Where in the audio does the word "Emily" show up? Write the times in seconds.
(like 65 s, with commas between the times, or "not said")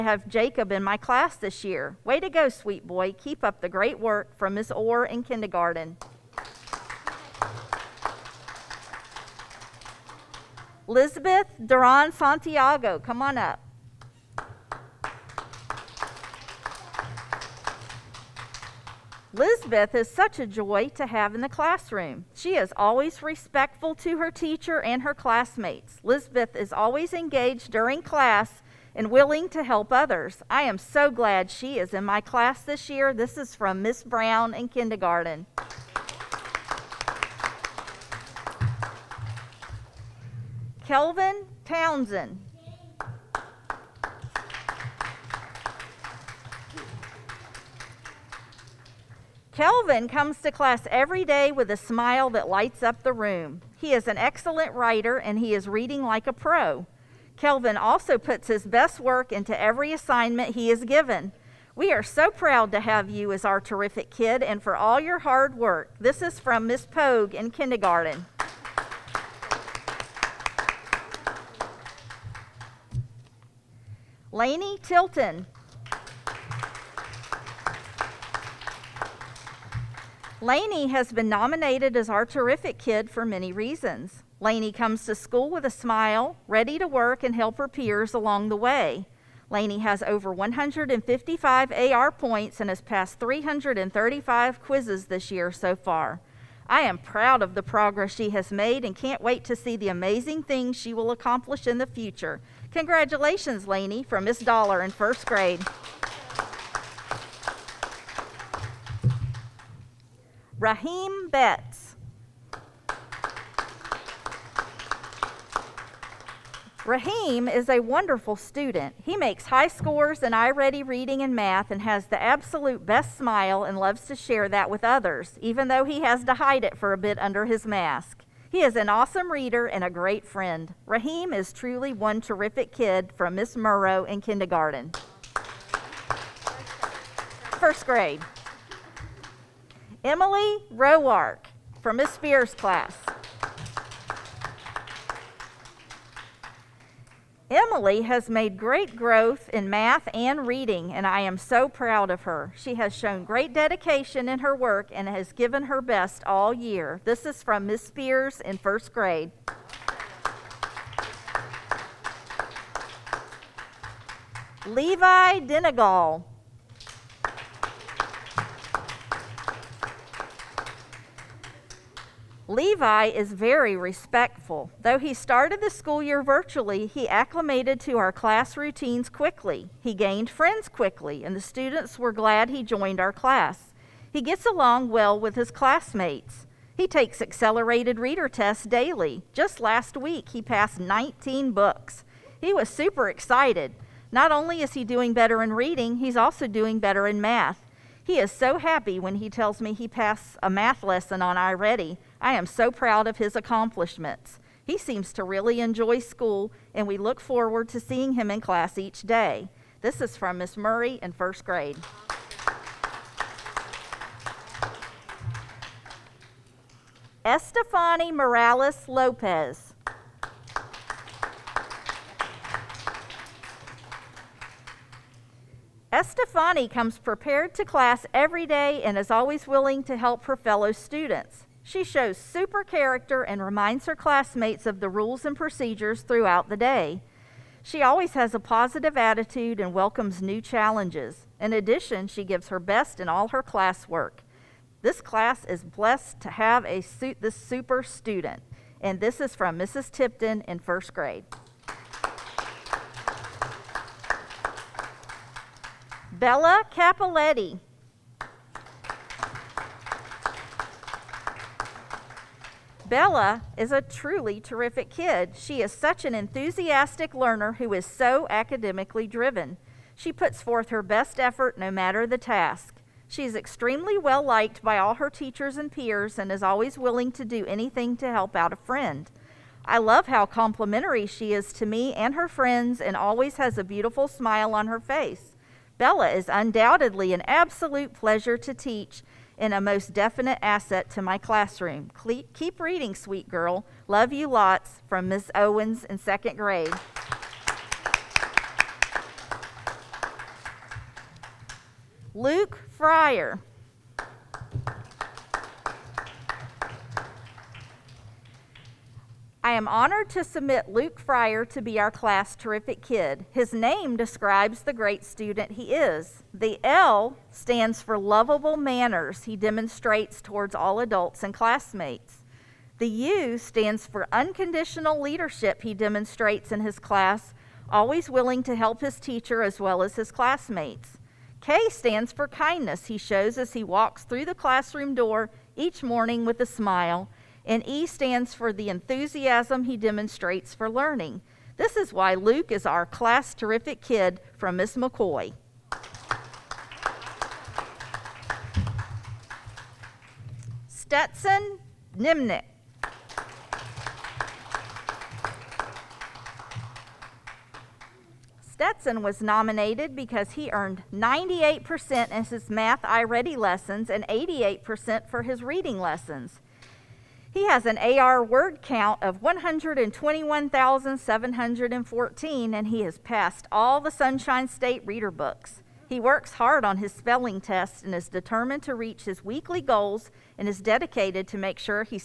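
140 s, 147 s.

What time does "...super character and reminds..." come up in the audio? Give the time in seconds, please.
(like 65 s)
232 s.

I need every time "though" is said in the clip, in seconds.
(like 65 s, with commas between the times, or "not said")
125 s, 174 s.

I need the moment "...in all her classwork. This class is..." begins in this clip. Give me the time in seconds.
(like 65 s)
243 s.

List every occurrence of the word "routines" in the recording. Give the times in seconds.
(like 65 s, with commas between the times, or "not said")
178 s.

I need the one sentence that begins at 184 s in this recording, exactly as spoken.
He gets along well with his classmates.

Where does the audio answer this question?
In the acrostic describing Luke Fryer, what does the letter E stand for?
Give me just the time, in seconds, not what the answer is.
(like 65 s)
338 s.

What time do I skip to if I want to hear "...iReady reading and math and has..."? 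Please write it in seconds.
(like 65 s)
120 s.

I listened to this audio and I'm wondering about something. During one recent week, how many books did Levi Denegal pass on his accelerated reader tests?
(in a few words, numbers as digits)
19.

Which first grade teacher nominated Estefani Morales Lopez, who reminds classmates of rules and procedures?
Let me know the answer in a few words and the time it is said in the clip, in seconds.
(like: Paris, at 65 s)
Mrs. Tipton, at 249 s.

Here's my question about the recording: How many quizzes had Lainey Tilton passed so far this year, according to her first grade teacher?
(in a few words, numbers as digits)
335.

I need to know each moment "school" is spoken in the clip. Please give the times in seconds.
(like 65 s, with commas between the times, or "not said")
85 s, 175 s, 205 s.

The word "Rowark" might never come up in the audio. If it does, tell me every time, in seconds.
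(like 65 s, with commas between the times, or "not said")
140 s.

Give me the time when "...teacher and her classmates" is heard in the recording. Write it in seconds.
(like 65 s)
24 s.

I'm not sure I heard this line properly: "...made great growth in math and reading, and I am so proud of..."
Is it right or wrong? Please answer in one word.
right.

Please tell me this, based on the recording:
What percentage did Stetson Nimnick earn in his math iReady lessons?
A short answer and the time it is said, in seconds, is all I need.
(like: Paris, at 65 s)
98%, at 360 s.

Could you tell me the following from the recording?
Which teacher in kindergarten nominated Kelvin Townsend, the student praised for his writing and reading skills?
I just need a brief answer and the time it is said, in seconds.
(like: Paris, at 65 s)
Miss Pogue, at 66 s.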